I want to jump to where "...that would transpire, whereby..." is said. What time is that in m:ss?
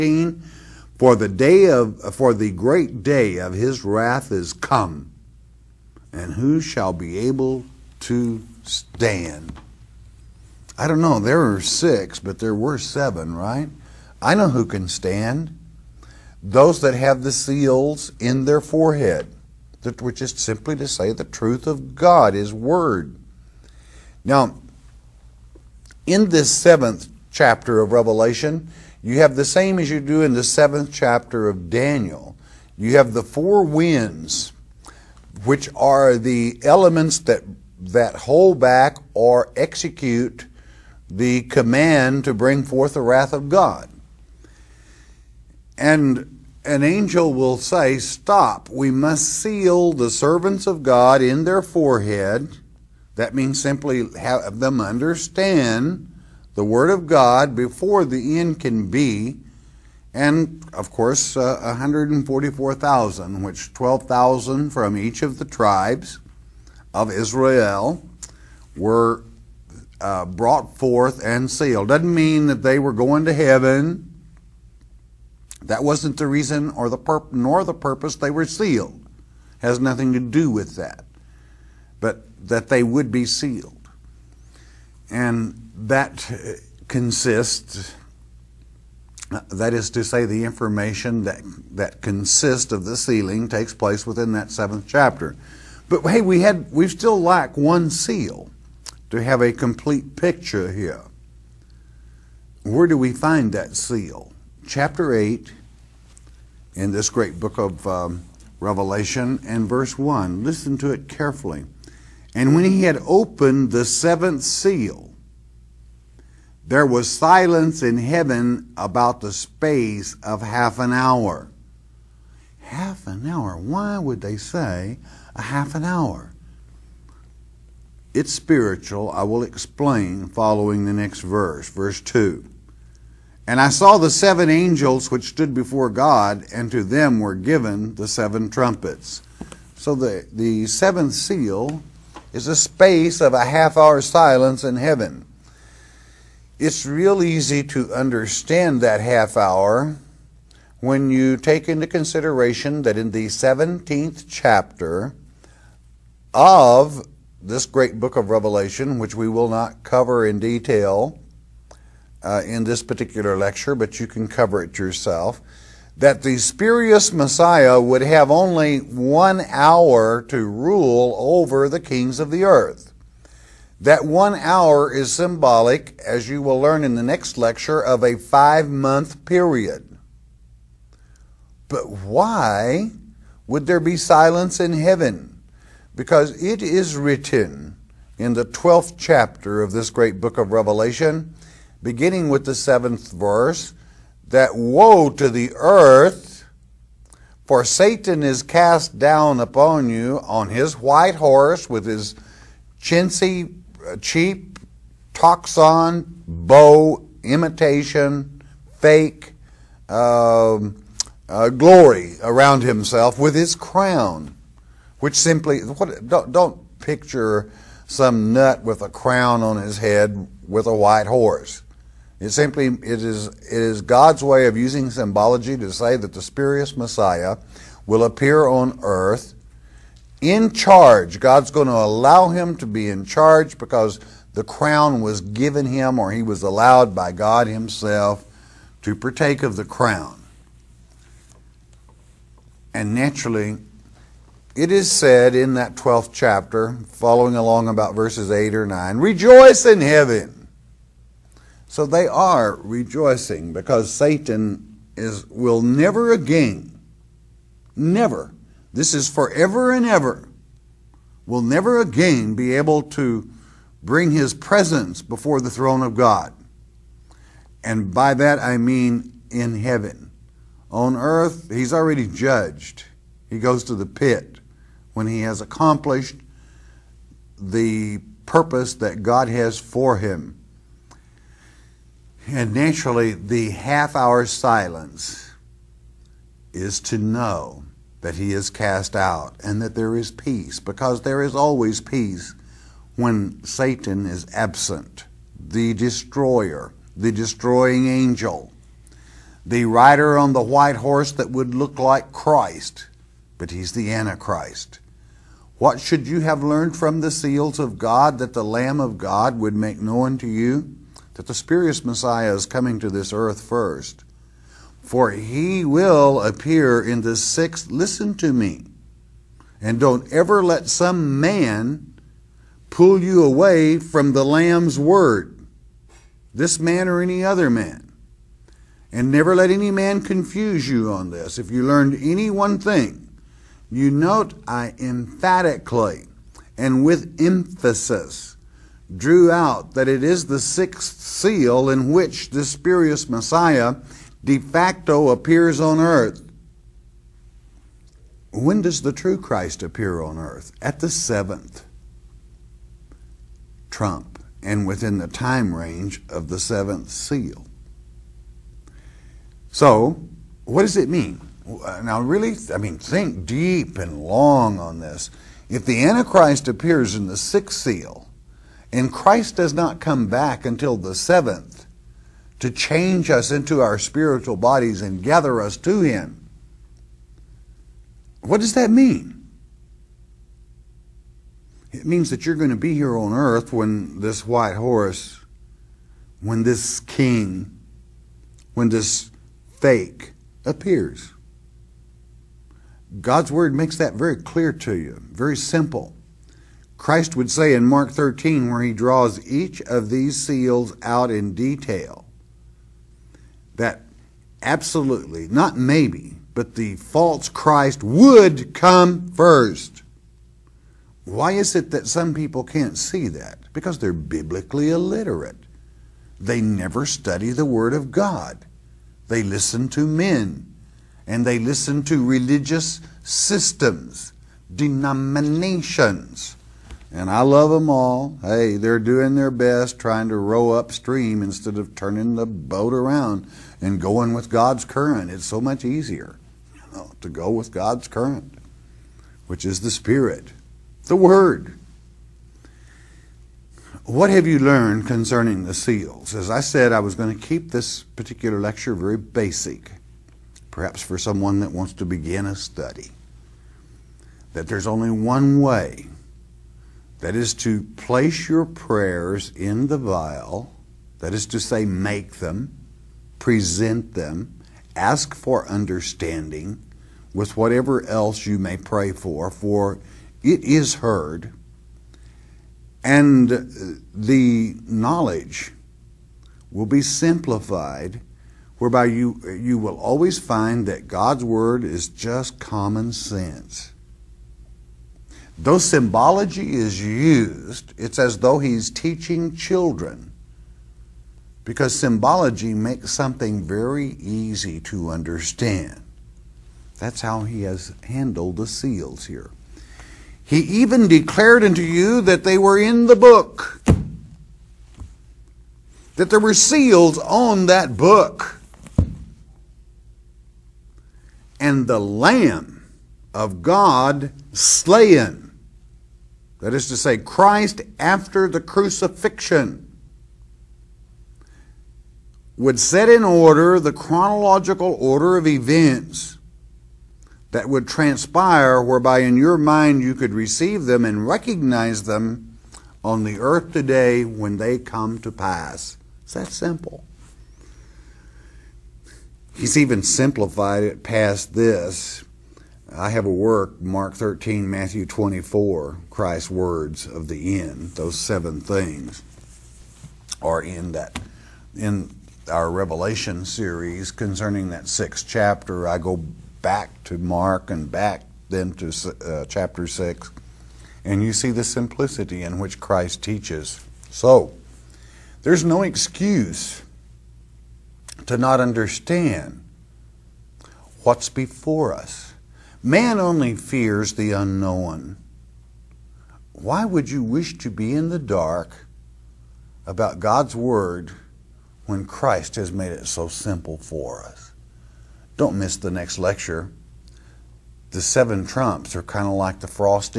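8:47.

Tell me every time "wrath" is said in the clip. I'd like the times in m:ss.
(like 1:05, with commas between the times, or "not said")
0:03, 0:43.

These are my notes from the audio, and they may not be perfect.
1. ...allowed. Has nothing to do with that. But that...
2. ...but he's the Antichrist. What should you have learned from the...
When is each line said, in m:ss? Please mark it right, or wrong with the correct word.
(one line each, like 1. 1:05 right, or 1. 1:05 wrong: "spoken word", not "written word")
1. 1:18 wrong: "sealed", not "allowed"
2. 5:03 right.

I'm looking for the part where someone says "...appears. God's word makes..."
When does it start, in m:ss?
6:30.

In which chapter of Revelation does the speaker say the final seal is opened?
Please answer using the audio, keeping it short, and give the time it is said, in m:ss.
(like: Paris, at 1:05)
Chapter 8, at 1:44.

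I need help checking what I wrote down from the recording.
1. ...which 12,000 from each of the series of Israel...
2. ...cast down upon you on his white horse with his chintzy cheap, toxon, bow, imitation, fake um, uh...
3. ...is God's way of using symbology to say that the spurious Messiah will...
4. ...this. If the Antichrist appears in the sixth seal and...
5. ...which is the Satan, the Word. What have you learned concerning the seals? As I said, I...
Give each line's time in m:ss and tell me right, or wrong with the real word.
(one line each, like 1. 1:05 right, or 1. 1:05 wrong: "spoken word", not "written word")
1. 1:03 wrong: "tribes", not "series"
2. 3:18 right
3. 3:43 right
4. 6:04 right
5. 7:19 wrong: "Spirit", not "Satan".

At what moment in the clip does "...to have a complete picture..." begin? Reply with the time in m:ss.
1:39.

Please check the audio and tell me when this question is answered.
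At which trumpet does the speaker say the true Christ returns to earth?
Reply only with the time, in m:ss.
5:50.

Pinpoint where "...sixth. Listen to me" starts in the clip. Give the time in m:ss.
5:17.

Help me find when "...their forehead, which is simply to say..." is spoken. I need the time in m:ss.
0:18.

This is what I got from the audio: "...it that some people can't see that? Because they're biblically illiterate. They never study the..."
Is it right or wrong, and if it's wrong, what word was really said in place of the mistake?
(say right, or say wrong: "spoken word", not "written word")
right.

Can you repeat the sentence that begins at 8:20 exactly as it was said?
He even declared unto you that they were in the book, that there were seals on that book.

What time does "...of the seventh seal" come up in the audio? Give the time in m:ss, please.
5:56.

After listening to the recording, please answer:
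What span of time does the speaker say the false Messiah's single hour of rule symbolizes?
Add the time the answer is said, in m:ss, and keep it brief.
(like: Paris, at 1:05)
5 months, at 2:58.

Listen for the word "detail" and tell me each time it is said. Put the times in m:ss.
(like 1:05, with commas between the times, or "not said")
2:40, 6:41.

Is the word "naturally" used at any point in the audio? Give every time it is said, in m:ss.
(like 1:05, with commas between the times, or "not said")
4:02, 4:42.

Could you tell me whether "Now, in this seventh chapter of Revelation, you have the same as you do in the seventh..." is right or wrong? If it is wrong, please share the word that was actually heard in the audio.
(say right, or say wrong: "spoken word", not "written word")
right.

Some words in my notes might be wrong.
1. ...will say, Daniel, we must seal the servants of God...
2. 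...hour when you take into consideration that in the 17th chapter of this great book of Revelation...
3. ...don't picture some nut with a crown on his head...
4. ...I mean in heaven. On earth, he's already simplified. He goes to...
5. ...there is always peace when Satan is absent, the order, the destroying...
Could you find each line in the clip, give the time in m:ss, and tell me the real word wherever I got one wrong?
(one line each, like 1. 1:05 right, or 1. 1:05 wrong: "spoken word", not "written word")
1. 0:47 wrong: "Stop", not "Daniel"
2. 2:29 right
3. 3:36 right
4. 4:28 wrong: "judged", not "simplified"
5. 4:51 wrong: "destroyer", not "order".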